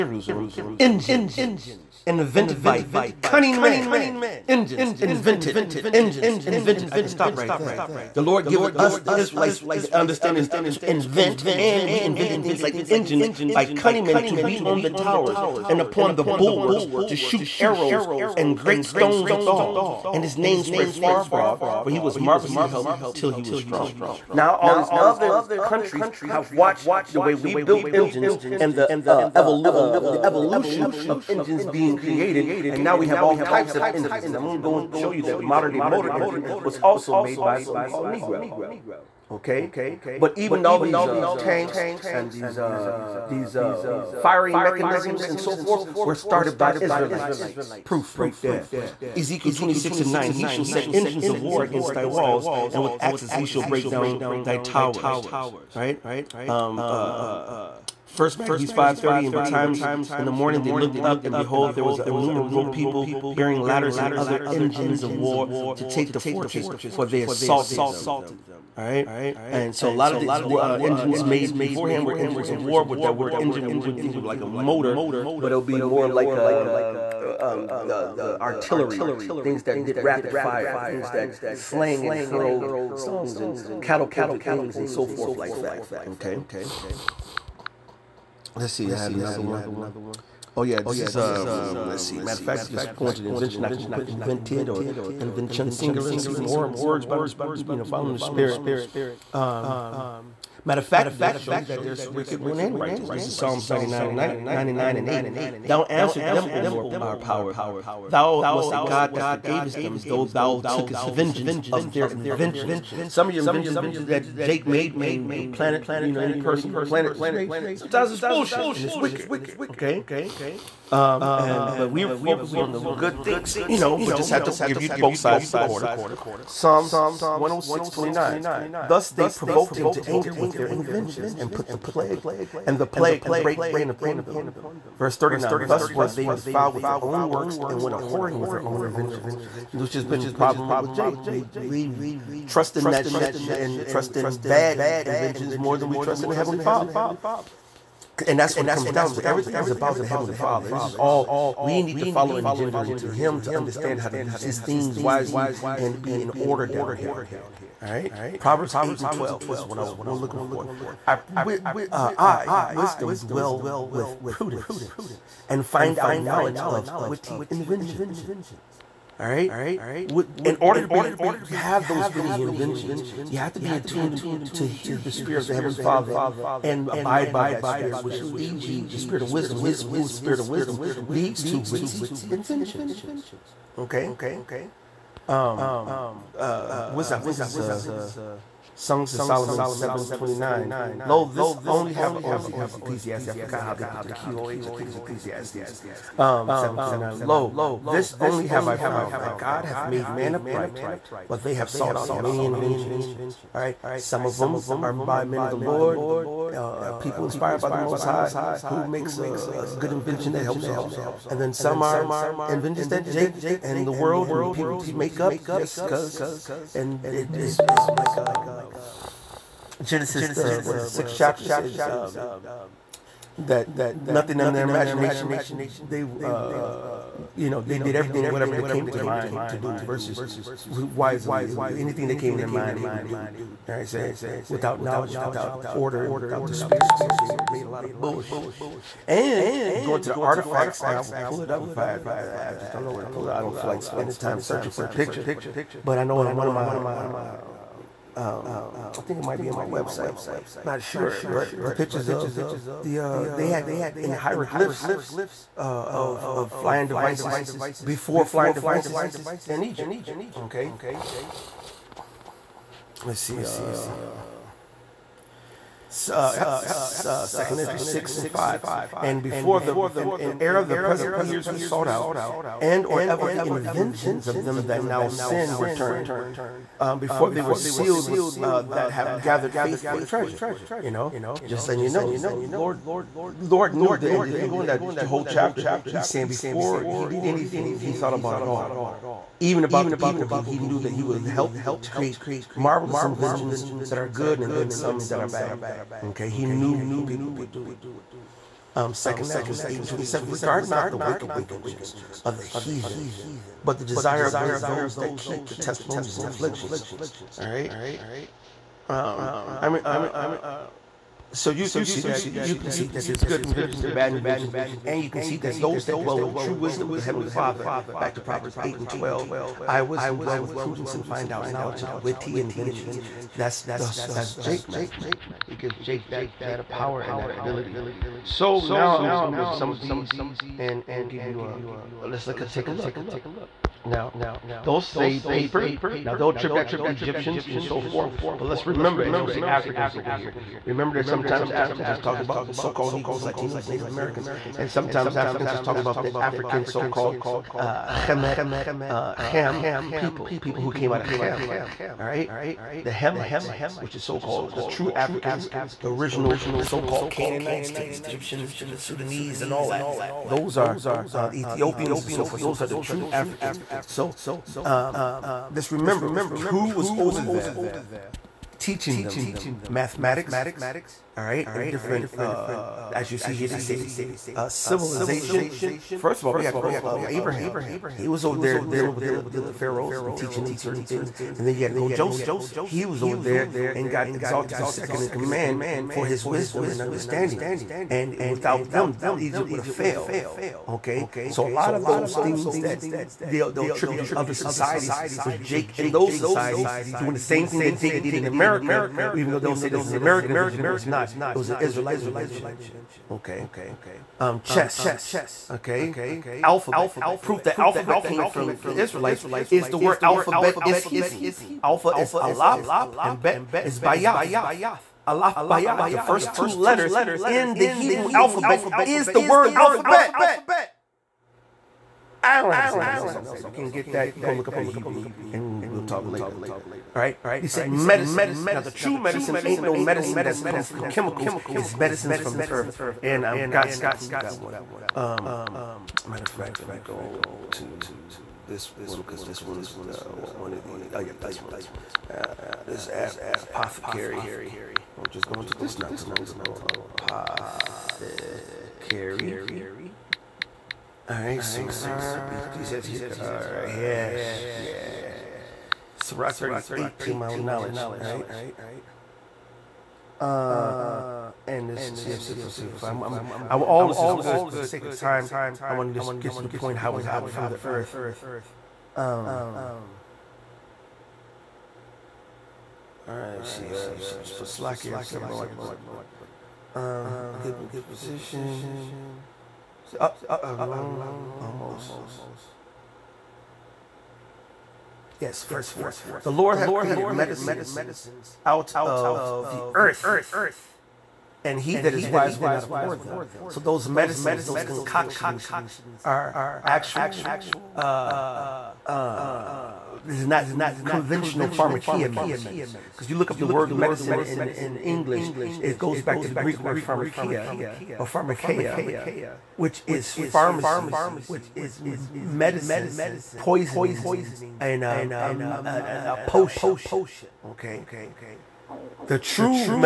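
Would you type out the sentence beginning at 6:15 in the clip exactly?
First of all, we had to go um, Abraham.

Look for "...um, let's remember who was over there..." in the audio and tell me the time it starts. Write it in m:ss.
6:04.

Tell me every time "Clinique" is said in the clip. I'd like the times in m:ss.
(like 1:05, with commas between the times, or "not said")
not said.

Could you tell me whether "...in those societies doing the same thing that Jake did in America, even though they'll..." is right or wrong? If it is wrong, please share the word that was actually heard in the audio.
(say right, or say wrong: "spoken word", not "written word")
right.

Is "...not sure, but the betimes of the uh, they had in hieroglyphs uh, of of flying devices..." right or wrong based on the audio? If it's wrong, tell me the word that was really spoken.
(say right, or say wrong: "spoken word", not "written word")
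wrong: "pictures", not "betimes".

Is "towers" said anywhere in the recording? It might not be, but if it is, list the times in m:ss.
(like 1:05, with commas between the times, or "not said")
0:14, 0:54.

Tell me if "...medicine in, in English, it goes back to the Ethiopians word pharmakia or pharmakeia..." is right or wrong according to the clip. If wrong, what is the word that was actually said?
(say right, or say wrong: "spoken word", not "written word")
wrong: "Greek", not "Ethiopians".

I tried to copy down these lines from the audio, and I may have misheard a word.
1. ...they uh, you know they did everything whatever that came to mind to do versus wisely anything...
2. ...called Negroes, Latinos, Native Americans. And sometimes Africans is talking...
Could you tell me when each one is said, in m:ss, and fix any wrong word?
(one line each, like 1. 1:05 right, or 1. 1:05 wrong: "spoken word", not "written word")
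1. 3:45 right
2. 5:42 right.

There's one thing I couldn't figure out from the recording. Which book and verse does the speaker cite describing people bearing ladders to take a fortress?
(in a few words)
First Maccabees 5:30.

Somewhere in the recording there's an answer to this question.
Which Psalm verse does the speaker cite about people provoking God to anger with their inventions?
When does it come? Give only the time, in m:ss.
2:06.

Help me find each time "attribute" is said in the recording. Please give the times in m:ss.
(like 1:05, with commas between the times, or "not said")
5:36, 6:33.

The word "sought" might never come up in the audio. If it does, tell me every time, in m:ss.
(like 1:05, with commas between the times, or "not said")
3:21, 4:31.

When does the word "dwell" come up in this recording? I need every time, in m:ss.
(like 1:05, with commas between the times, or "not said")
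2:43, 5:15, 5:20.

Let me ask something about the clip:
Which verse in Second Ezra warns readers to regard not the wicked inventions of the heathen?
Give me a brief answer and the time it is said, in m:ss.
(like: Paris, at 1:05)
Second Ezra 8:27, at 4:58.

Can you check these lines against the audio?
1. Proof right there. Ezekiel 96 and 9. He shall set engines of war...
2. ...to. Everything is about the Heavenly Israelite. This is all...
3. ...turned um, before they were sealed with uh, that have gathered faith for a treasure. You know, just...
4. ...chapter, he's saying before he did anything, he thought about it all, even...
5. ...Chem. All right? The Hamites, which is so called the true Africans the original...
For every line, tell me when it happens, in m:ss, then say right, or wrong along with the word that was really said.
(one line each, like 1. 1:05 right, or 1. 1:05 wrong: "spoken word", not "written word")
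1. 0:47 wrong: "26", not "96"
2. 2:29 wrong: "Father", not "Israelite"
3. 4:35 right
4. 4:45 right
5. 5:51 right.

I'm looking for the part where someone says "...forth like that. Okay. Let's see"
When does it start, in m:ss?
1:25.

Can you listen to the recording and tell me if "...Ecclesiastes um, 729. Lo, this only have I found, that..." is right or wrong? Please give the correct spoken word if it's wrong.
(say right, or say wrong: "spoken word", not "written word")
right.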